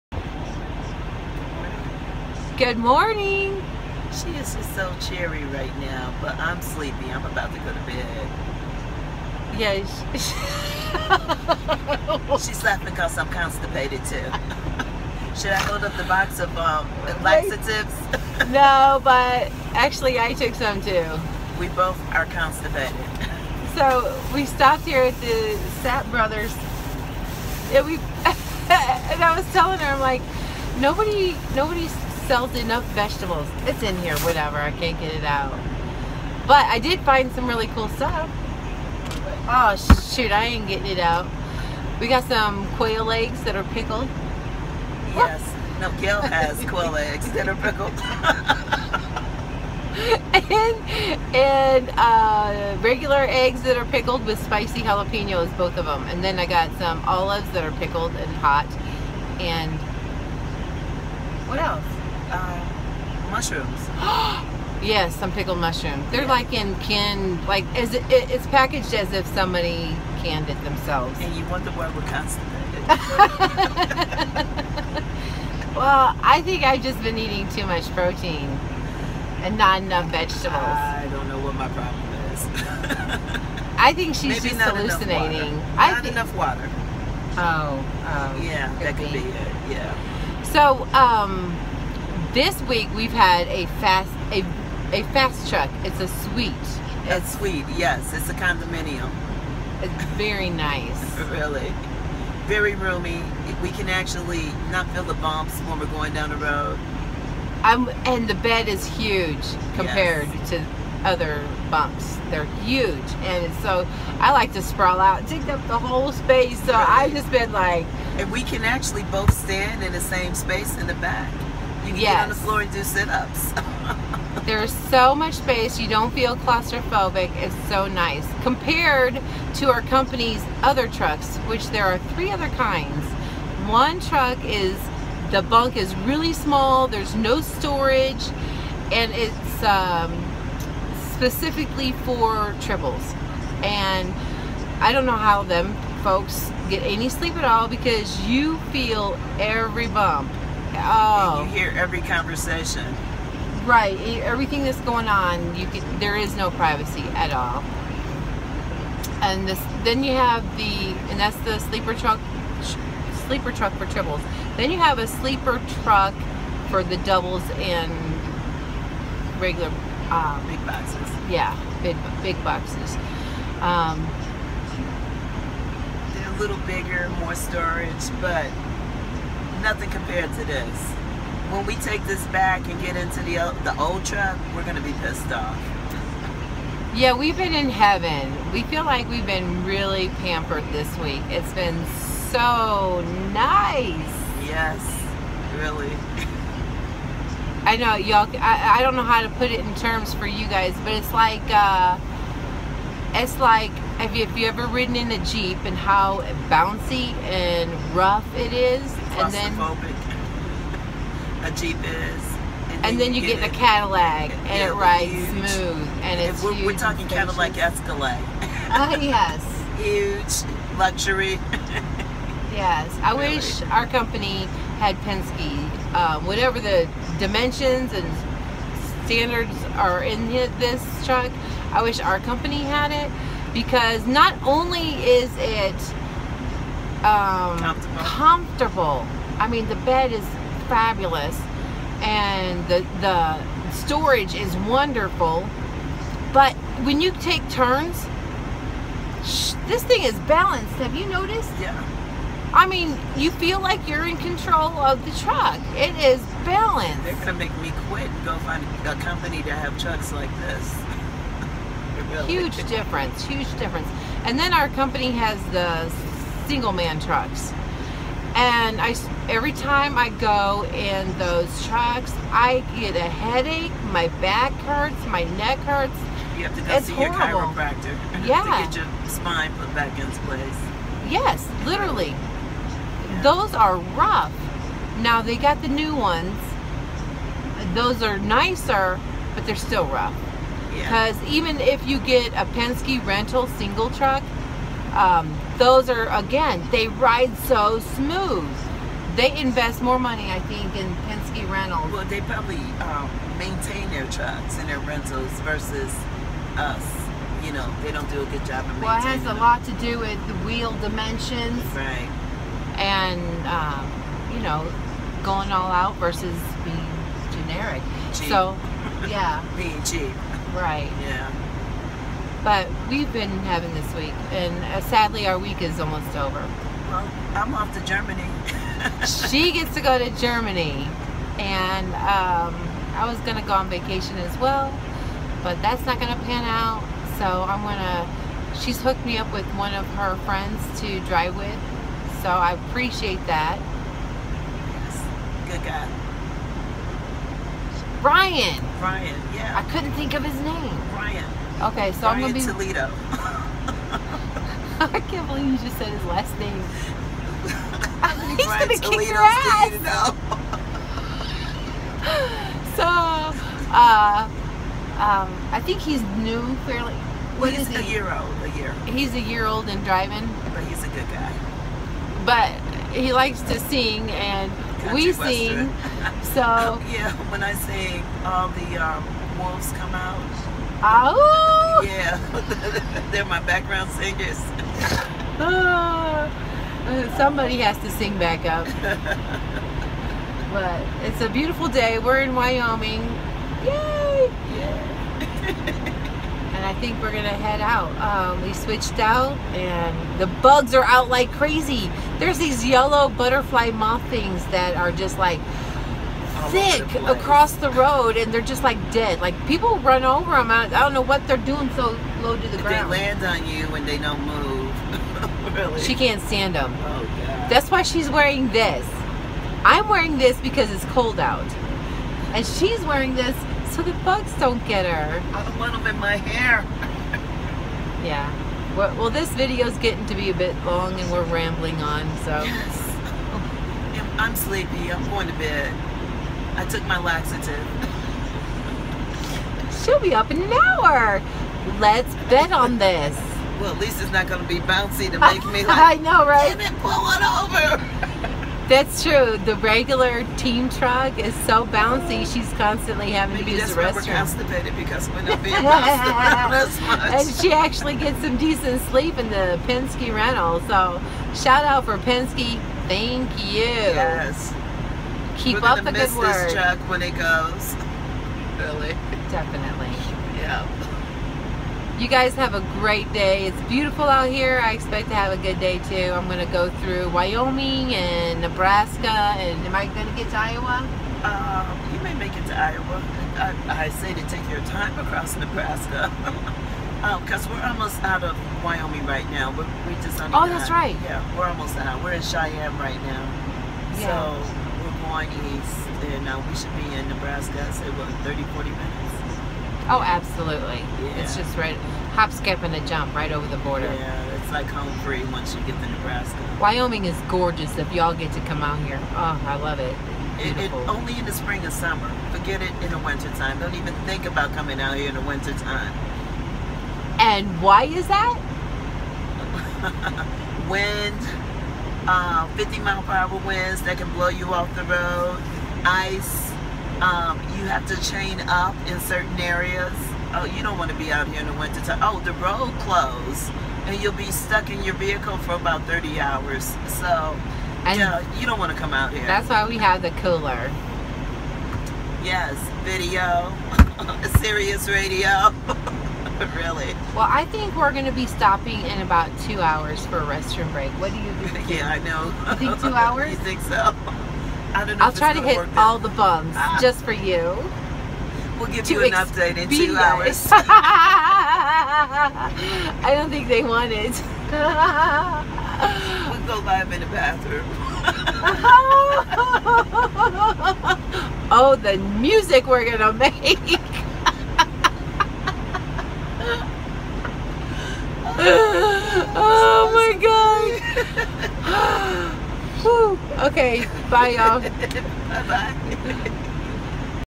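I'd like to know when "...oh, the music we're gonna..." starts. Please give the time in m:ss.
9:31.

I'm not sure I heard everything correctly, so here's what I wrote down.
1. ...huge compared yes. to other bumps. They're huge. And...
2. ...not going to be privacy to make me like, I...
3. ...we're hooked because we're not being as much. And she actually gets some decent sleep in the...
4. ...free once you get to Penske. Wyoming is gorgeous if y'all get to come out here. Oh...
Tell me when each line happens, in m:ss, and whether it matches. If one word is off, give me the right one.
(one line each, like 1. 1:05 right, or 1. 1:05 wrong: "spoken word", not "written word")
1. 1:48 right
2. 7:24 wrong: "bouncy", not "privacy"
3. 7:34 wrong: "constipated", not "hooked"
4. 8:24 wrong: "Nebraska", not "Penske".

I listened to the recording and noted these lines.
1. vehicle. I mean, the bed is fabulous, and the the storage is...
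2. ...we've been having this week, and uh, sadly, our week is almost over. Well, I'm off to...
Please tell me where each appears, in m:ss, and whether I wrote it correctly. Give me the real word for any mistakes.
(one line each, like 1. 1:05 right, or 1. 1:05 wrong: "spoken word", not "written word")
1. 3:58 wrong: "comfortable", not "vehicle"
2. 5:22 right.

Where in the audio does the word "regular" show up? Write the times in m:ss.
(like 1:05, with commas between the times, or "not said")
0:52, 2:49, 7:29.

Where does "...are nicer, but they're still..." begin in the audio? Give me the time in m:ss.
4:48.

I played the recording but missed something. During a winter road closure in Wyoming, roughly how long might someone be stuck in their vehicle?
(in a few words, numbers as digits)
30 hours.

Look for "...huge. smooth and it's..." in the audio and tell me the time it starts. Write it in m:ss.
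3:35.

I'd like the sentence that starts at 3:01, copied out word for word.
When we take this back and get into the, the old truck, we're going to be pissed off.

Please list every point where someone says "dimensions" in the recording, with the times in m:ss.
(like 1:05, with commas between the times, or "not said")
3:47, 5:10.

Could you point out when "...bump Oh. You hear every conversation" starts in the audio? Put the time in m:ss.
2:29.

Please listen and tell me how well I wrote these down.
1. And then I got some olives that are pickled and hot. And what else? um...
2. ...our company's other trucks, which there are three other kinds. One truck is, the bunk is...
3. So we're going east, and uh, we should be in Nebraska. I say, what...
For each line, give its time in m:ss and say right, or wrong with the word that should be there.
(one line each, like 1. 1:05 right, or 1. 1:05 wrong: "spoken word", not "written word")
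1. 0:56 right
2. 2:09 right
3. 8:14 right.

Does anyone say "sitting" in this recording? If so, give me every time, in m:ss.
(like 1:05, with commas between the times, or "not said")
not said.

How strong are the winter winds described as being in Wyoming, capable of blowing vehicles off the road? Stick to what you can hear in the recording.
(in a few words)
50 mph.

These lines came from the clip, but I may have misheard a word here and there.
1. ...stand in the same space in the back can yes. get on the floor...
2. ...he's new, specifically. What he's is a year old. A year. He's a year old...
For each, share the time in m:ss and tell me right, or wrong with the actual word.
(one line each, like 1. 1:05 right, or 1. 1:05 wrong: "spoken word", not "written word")
1. 1:59 right
2. 6:05 wrong: "fairly", not "specifically".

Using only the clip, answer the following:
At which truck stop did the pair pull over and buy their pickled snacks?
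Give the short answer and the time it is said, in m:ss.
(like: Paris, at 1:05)
Sapp Brothers, at 0:25.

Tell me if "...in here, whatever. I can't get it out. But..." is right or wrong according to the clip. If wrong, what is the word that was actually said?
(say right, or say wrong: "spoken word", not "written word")
right.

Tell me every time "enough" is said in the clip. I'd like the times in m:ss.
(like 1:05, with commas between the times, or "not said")
0:32, 1:19, 1:26.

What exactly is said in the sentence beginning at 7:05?
I don't want them in my hair.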